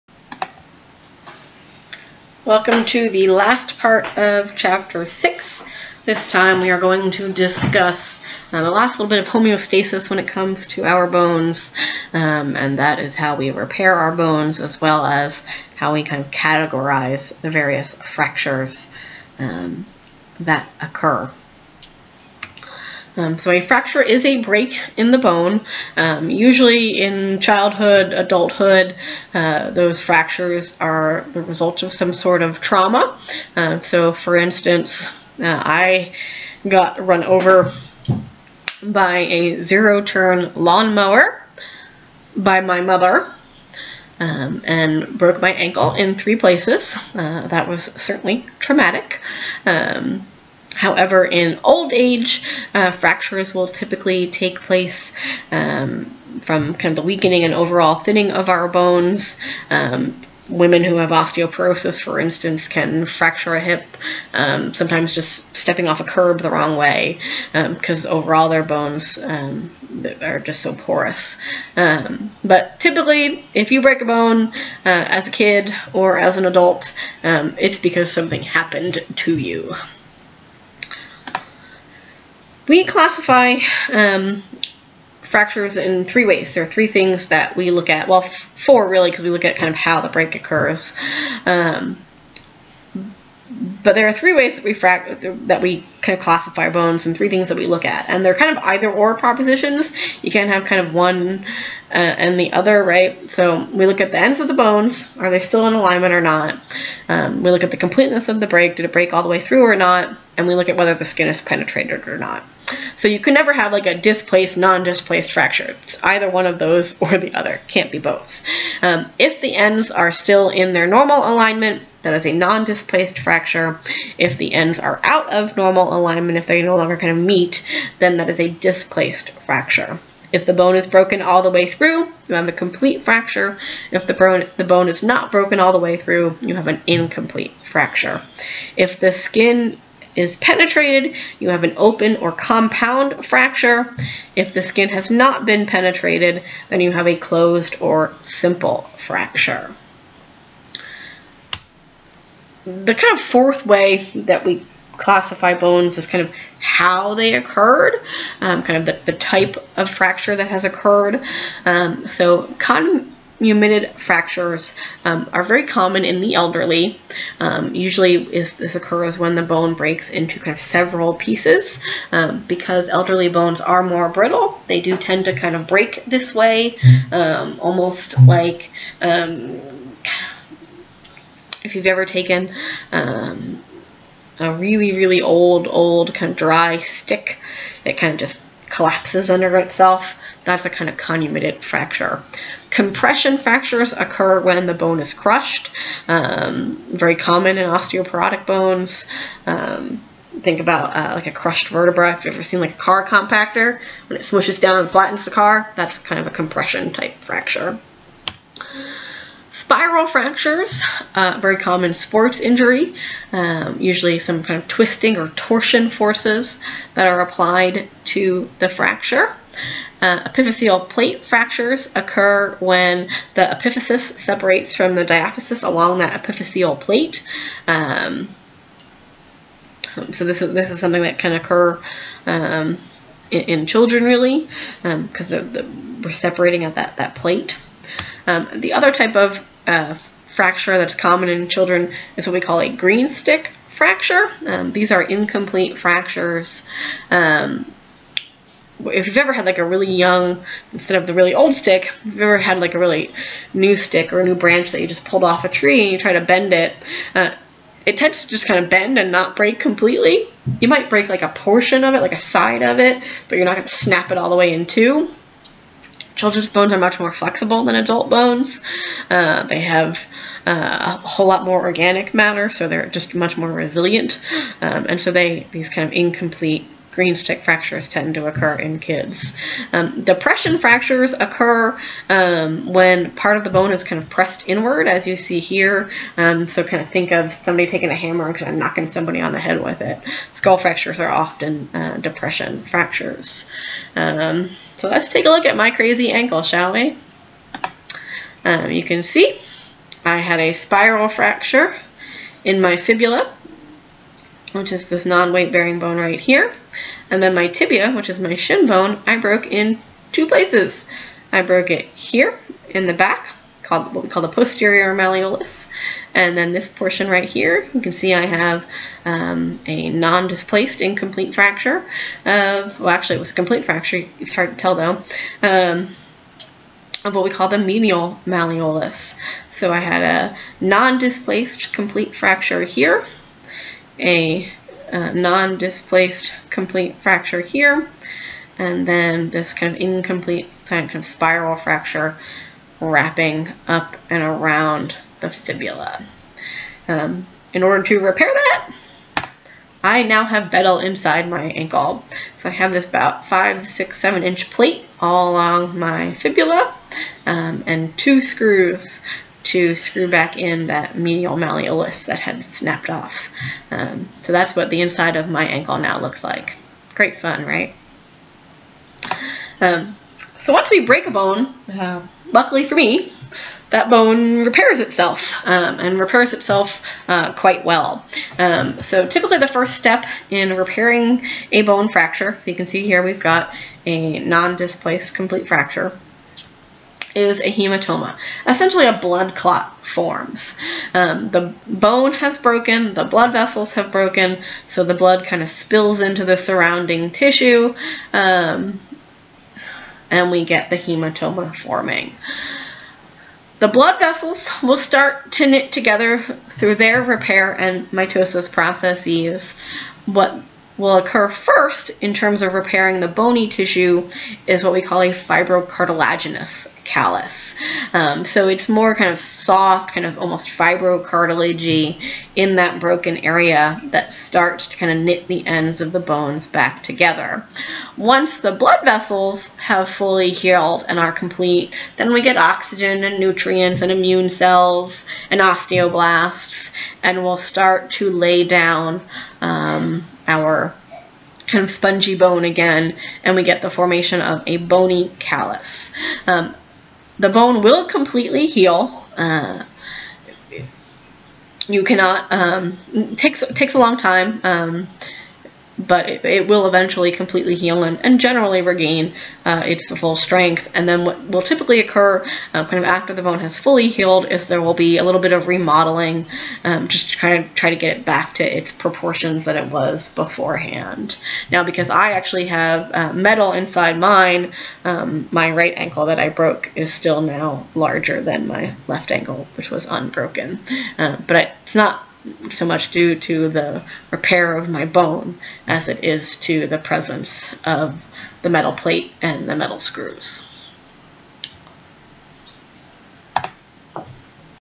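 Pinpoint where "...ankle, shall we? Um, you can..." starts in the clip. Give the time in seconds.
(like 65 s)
296 s.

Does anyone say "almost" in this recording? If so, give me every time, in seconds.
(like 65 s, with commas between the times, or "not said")
177 s, 420 s.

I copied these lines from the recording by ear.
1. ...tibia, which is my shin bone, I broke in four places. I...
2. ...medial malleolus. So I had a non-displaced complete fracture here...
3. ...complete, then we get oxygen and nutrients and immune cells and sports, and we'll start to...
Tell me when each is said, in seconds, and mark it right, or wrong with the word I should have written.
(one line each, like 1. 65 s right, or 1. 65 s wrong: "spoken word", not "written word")
1. 307 s wrong: "two", not "four"
2. 327 s right
3. 431 s wrong: "osteoblasts", not "sports".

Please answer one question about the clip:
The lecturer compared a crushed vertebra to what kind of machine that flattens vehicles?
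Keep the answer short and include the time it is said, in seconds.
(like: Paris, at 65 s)
car compactor, at 202 s.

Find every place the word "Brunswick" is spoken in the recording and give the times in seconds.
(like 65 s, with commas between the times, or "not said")
not said.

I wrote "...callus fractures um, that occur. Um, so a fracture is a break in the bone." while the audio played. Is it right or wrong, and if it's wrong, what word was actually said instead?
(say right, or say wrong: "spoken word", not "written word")
wrong: "various", not "callus".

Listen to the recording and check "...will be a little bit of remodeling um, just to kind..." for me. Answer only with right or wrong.
right.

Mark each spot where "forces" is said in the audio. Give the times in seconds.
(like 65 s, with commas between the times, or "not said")
215 s.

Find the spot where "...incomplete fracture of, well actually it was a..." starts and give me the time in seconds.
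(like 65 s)
320 s.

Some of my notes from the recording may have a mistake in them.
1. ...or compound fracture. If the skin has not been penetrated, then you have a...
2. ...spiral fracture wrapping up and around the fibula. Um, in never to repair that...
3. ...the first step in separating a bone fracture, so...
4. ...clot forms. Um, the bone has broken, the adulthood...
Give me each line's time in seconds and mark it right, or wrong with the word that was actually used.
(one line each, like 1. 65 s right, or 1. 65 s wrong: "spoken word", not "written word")
1. 142 s right
2. 341 s wrong: "order", not "never"
3. 379 s wrong: "repairing", not "separating"
4. 389 s wrong: "blood", not "adulthood".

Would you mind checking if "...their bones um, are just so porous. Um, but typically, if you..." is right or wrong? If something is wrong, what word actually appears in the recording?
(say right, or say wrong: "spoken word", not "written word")
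right.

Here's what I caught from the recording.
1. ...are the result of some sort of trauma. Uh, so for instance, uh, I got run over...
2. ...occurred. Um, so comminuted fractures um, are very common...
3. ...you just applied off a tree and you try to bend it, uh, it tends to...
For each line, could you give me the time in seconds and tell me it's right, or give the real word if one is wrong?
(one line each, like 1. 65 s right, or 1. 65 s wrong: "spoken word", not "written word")
1. 30 s right
2. 160 s right
3. 254 s wrong: "pulled", not "applied".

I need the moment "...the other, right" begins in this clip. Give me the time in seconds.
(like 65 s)
102 s.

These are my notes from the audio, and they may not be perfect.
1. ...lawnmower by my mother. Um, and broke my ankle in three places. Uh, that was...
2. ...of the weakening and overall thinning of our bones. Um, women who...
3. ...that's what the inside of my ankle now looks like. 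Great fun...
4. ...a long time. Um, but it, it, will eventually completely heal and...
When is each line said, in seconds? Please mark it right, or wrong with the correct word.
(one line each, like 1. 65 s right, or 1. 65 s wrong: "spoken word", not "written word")
1. 40 s right
2. 56 s right
3. 364 s right
4. 453 s right.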